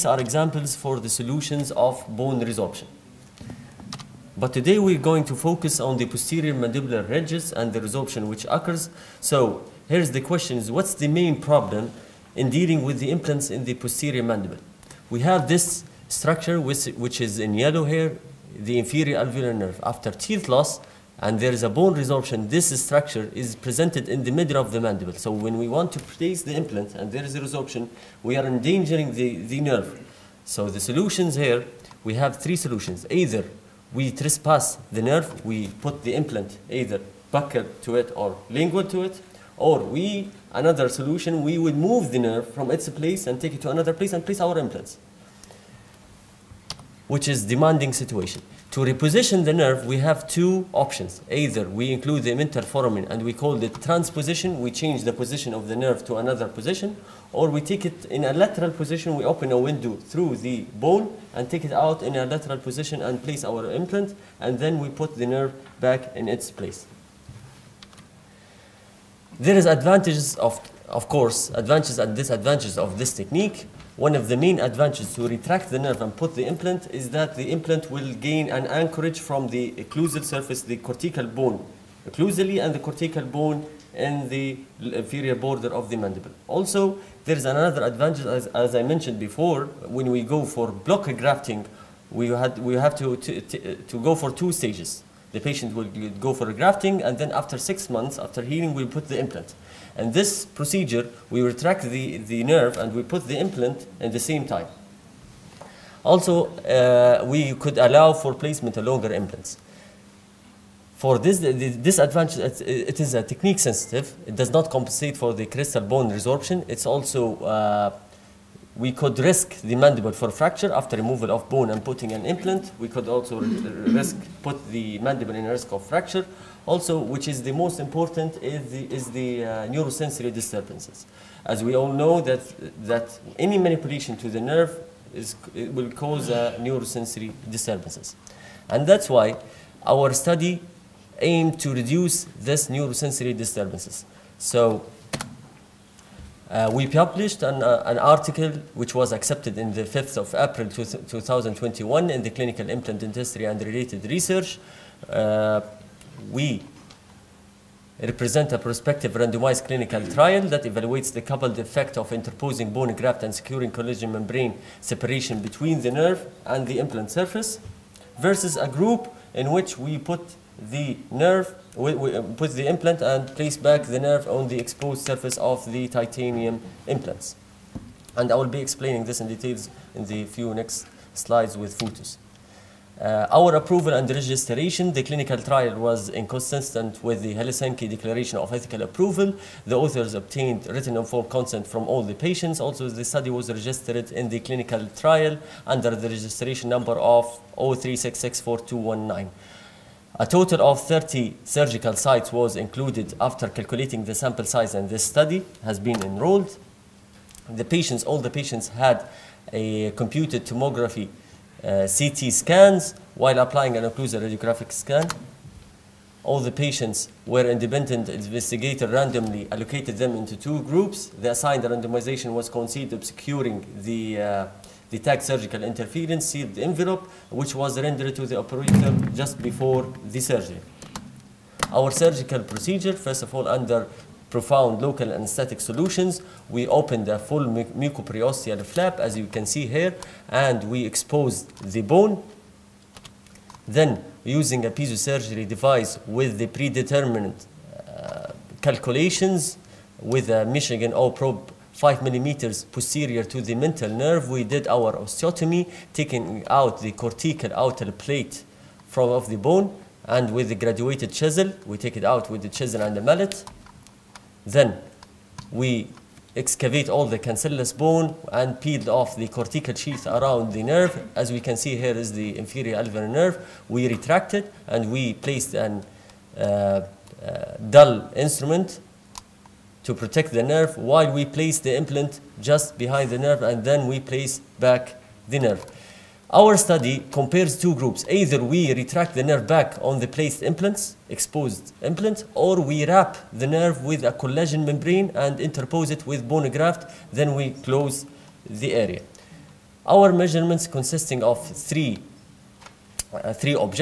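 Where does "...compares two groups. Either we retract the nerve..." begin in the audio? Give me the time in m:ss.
4:47.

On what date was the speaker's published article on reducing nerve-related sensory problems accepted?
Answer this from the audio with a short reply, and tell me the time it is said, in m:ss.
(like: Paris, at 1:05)
5 April 2021, at 2:29.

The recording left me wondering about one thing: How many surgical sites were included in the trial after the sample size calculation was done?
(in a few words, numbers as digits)
30.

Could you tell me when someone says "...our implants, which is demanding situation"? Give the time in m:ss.
0:44.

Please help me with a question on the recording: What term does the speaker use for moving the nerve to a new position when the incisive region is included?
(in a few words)
transposition.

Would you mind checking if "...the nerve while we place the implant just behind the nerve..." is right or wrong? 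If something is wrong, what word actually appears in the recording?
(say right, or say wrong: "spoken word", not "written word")
right.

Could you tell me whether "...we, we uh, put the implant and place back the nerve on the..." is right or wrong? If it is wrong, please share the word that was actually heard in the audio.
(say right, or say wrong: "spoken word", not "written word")
right.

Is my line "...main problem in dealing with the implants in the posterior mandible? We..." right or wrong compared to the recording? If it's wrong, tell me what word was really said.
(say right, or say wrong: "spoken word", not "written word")
right.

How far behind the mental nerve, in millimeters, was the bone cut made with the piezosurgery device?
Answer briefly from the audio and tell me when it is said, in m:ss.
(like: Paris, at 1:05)
5 millimeters, at 4:11.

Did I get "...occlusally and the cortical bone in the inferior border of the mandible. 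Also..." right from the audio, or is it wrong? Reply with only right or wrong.
right.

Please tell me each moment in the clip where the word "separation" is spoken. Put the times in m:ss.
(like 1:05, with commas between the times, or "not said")
2:44.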